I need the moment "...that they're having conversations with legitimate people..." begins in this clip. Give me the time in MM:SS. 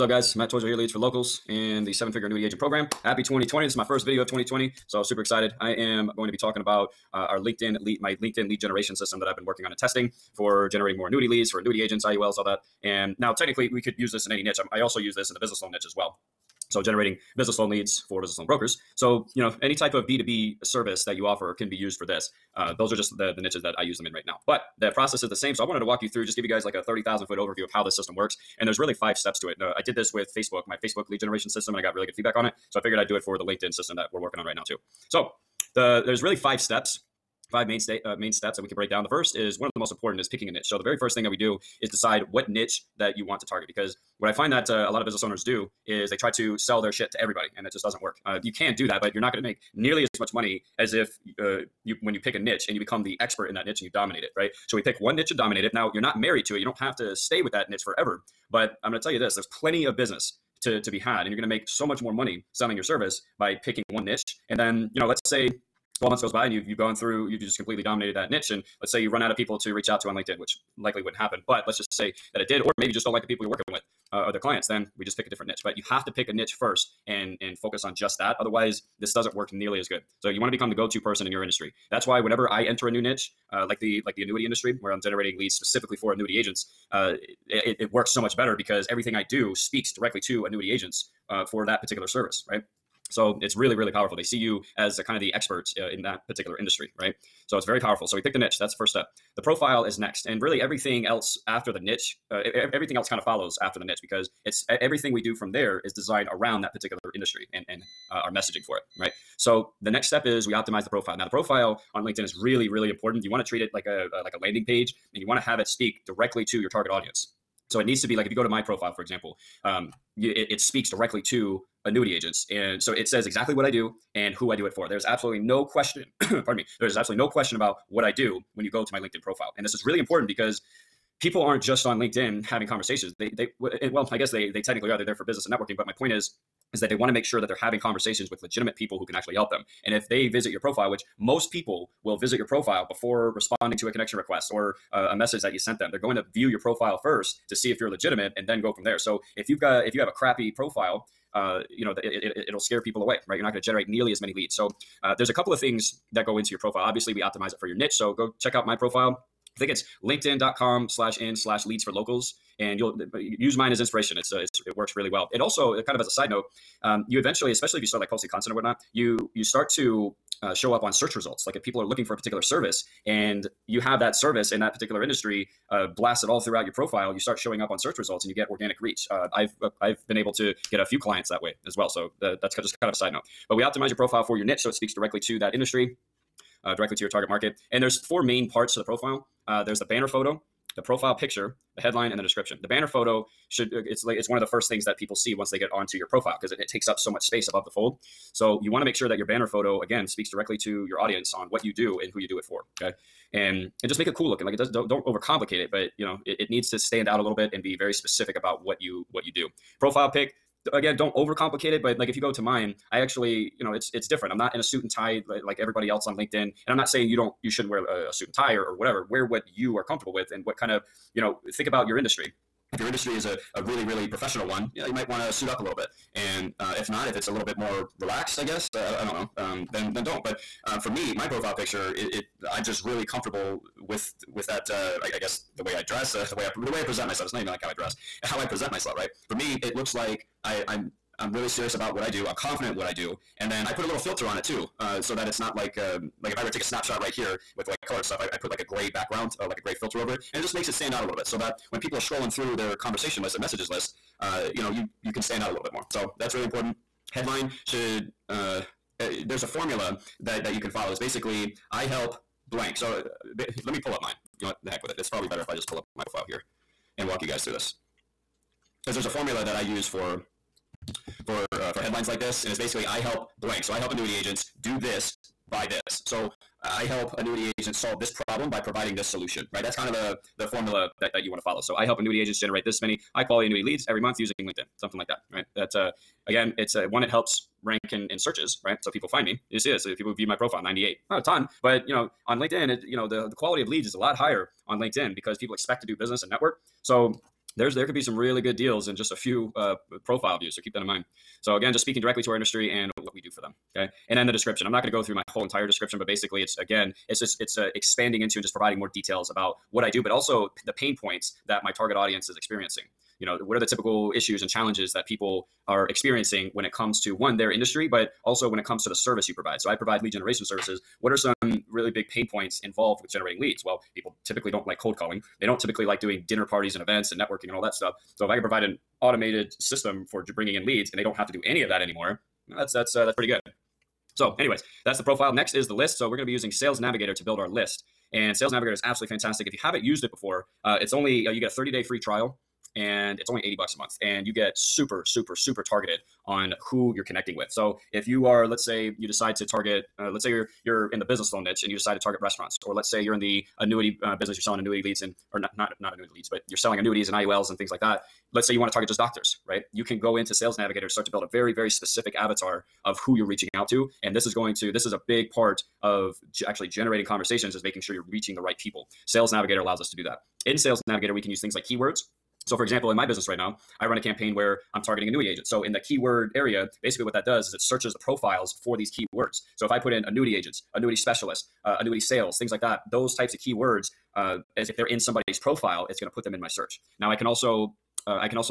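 02:17.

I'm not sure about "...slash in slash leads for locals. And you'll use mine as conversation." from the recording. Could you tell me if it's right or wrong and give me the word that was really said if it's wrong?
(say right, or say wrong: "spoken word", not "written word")
wrong: "inspiration", not "conversation".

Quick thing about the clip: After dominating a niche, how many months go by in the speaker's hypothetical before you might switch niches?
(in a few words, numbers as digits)
12.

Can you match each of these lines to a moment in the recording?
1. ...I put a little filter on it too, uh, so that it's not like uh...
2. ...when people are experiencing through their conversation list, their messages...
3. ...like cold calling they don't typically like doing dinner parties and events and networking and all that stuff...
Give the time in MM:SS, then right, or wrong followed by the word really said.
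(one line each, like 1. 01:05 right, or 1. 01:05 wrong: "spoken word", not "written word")
1. 04:03 right
2. 04:11 wrong: "scrolling", not "experiencing"
3. 05:24 right.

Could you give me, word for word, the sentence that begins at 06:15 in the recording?
So, in the keyword area, basically what that does is it searches the profiles for these keywords.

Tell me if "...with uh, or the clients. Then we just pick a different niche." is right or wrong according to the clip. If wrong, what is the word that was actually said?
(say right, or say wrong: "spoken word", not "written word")
right.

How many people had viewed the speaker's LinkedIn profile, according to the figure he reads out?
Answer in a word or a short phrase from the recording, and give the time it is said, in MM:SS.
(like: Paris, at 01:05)
98, at 04:50.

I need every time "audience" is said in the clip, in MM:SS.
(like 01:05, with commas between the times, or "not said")
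01:56, 03:20, 05:11.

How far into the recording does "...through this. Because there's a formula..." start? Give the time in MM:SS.
04:27.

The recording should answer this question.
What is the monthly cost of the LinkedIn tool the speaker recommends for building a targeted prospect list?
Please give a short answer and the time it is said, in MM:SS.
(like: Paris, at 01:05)
80 dollars, at 05:43.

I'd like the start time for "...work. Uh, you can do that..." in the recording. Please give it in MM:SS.
00:48.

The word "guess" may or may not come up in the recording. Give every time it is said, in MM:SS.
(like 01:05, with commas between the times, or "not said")
02:14, 03:48, 03:55.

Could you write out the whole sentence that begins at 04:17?
Headline should uh, eh, there's a formula that that you can follow.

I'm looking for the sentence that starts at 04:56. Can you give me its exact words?
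So there's there could be some really good deals in just a few uh, profile views.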